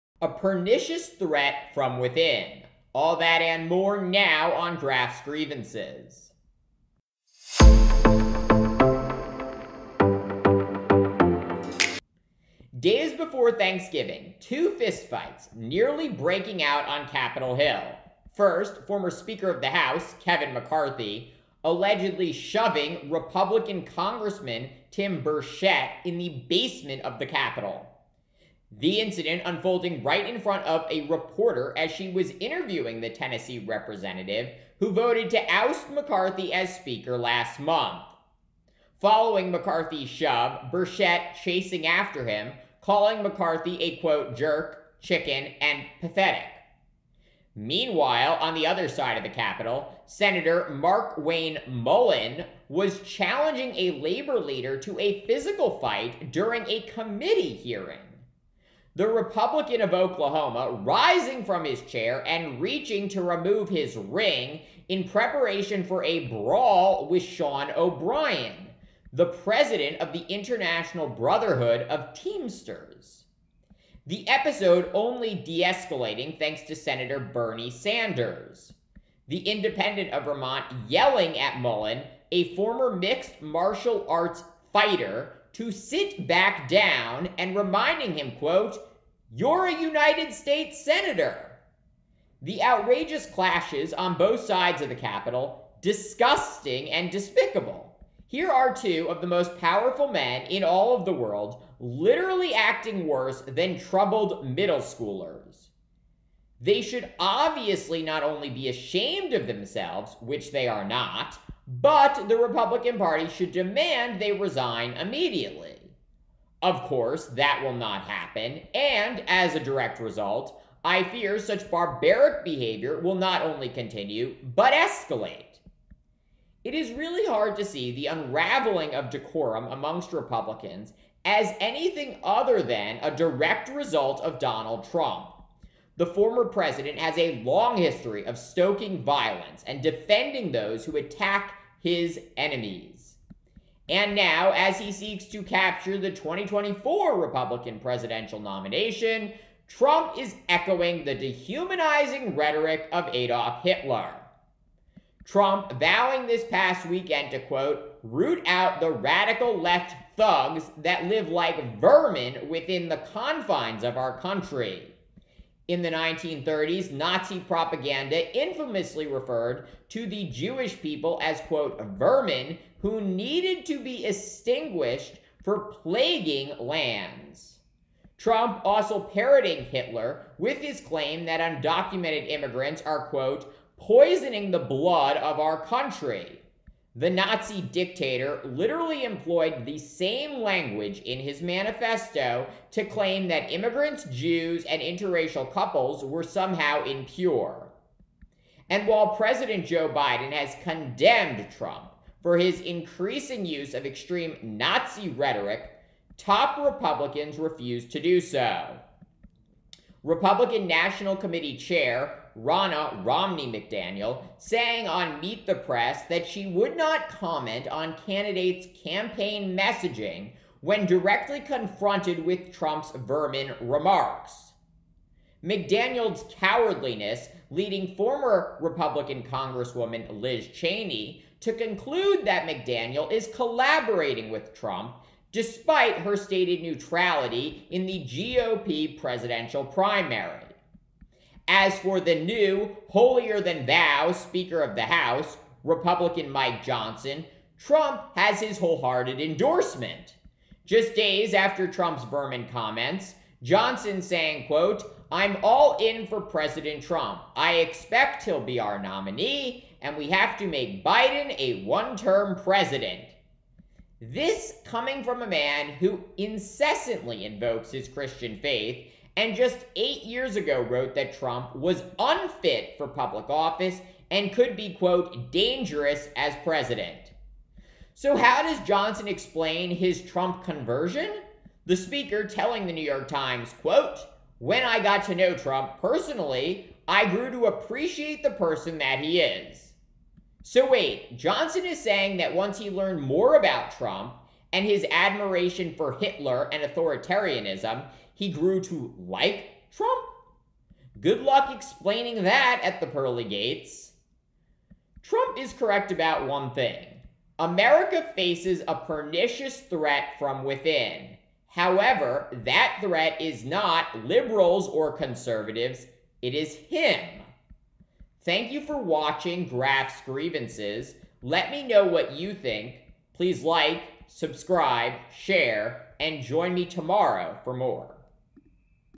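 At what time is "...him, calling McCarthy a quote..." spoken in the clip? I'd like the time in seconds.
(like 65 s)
42 s.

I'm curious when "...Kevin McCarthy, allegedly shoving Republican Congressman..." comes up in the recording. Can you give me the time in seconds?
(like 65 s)
20 s.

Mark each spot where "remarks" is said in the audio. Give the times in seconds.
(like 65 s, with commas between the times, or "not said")
223 s.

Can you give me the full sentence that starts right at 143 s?
And now, as he seeks to capture the 2024 Republican presidential nomination, Trump is echoing the dehumanizing rhetoric of Adolf Hitler.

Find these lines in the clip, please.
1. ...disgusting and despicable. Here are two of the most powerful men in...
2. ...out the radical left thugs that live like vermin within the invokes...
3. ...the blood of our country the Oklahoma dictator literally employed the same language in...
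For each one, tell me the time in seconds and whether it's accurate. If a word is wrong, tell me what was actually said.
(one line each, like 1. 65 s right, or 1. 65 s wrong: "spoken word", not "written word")
1. 95 s right
2. 158 s wrong: "confines", not "invokes"
3. 184 s wrong: "Nazi", not "Oklahoma".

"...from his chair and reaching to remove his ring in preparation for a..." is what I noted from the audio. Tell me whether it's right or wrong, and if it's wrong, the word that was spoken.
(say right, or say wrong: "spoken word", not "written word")
right.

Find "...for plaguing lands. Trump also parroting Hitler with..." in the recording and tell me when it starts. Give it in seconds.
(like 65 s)
175 s.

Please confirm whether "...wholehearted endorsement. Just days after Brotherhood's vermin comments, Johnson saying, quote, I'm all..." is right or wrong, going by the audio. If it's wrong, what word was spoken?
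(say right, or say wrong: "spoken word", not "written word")
wrong: "Trump", not "Brotherhood".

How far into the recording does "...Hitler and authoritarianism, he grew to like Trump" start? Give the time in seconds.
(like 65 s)
295 s.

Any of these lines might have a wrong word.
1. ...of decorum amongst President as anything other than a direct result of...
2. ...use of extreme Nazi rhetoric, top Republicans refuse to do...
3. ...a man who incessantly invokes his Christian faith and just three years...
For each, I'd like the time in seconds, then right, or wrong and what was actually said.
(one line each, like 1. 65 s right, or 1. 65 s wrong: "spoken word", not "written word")
1. 128 s wrong: "Republicans", not "President"
2. 203 s right
3. 265 s wrong: "eight", not "three".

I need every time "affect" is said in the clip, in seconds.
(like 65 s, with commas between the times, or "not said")
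not said.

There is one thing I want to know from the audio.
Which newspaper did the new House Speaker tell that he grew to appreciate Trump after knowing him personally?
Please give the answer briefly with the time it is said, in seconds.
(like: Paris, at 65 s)
New York Times, at 282 s.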